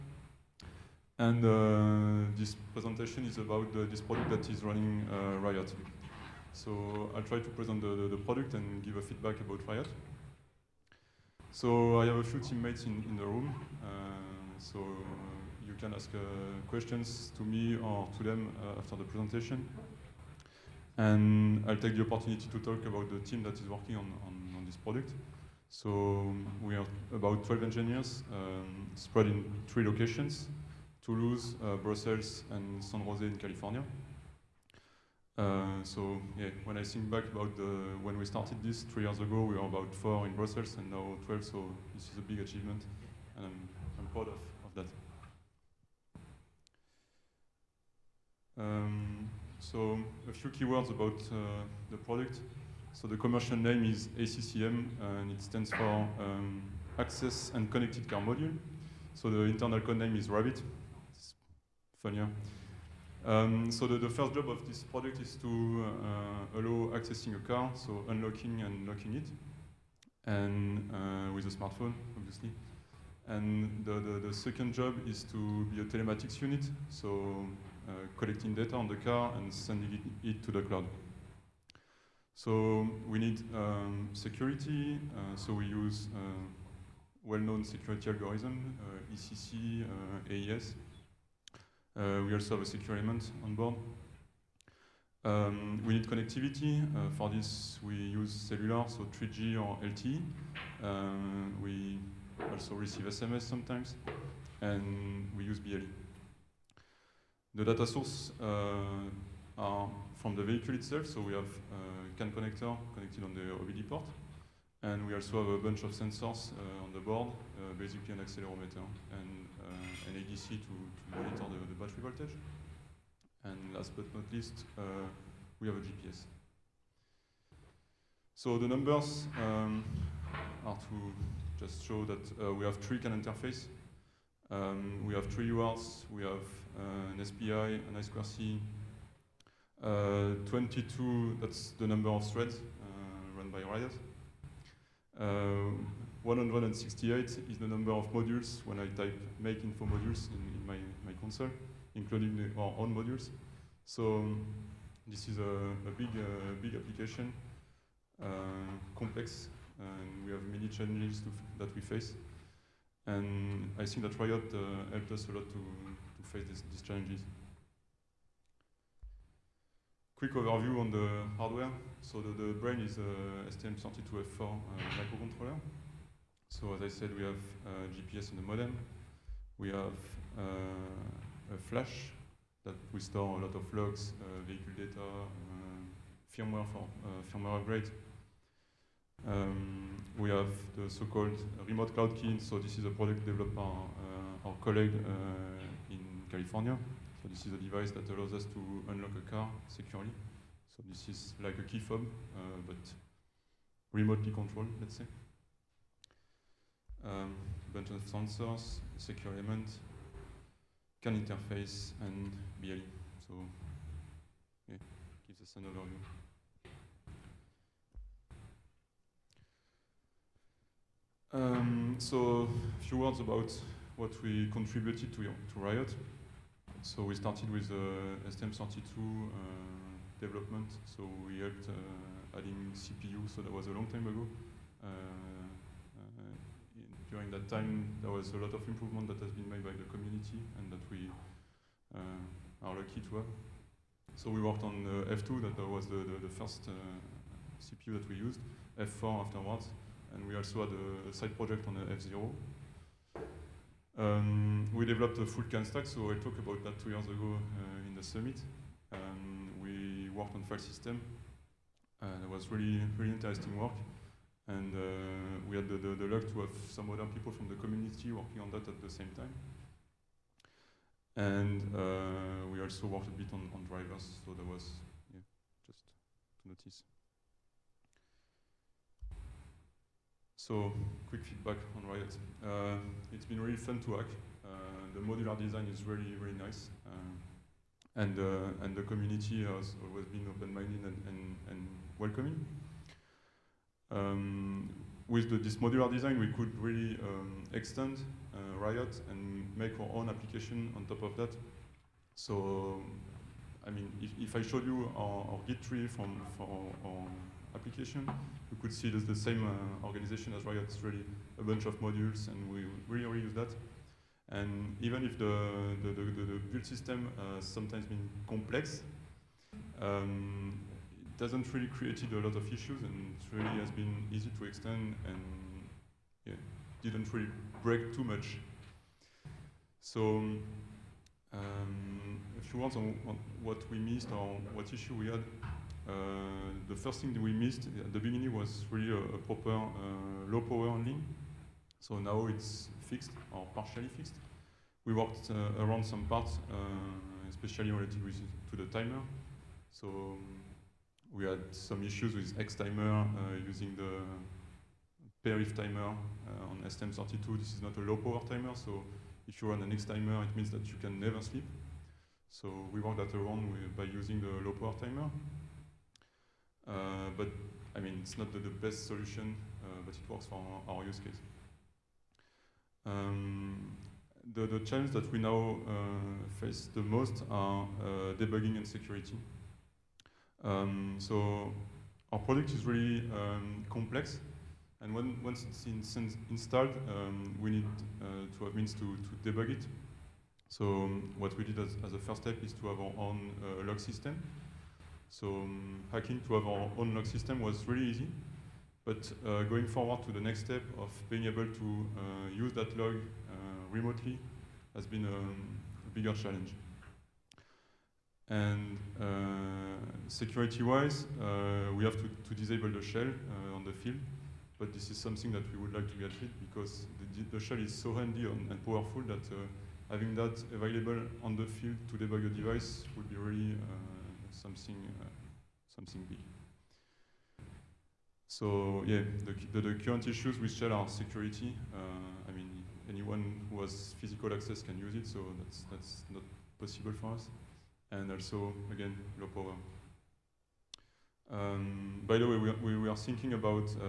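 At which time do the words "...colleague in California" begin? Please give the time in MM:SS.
03:14.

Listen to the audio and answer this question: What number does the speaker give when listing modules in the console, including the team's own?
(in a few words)
168.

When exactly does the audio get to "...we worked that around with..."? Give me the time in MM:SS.
06:02.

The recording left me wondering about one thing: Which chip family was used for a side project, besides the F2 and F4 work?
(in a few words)
F0.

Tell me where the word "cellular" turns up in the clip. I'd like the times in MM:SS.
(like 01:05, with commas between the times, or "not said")
01:38.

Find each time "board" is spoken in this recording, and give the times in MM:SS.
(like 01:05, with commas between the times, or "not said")
01:33, 01:56.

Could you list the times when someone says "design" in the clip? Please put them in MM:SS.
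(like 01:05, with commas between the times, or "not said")
04:45, 04:55.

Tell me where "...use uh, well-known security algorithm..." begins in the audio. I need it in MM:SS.
01:25.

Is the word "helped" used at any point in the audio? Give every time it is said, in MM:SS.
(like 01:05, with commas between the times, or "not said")
02:44, 03:51.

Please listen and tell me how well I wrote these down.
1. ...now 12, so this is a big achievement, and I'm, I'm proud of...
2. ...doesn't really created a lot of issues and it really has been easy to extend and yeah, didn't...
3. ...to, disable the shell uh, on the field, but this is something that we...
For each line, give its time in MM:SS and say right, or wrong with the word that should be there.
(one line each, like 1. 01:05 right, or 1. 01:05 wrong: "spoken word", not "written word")
1. 00:40 right
2. 05:21 right
3. 06:52 right.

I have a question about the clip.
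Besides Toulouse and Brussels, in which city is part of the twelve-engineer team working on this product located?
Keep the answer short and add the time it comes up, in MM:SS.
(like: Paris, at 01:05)
San Jose, at 00:32.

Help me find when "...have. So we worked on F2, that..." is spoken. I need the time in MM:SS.
04:03.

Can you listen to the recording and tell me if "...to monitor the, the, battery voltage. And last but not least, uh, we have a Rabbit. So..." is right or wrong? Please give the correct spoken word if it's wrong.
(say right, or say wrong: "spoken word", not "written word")
wrong: "GPS", not "Rabbit".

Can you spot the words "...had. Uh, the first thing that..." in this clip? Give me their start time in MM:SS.
05:35.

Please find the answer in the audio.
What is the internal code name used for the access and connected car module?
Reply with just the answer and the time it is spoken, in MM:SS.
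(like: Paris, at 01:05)
Rabbit, at 01:00.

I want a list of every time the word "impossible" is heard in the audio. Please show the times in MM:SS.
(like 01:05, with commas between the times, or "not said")
not said.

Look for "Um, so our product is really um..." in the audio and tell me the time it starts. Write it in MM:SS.
06:20.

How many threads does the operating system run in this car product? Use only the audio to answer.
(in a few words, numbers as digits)
22.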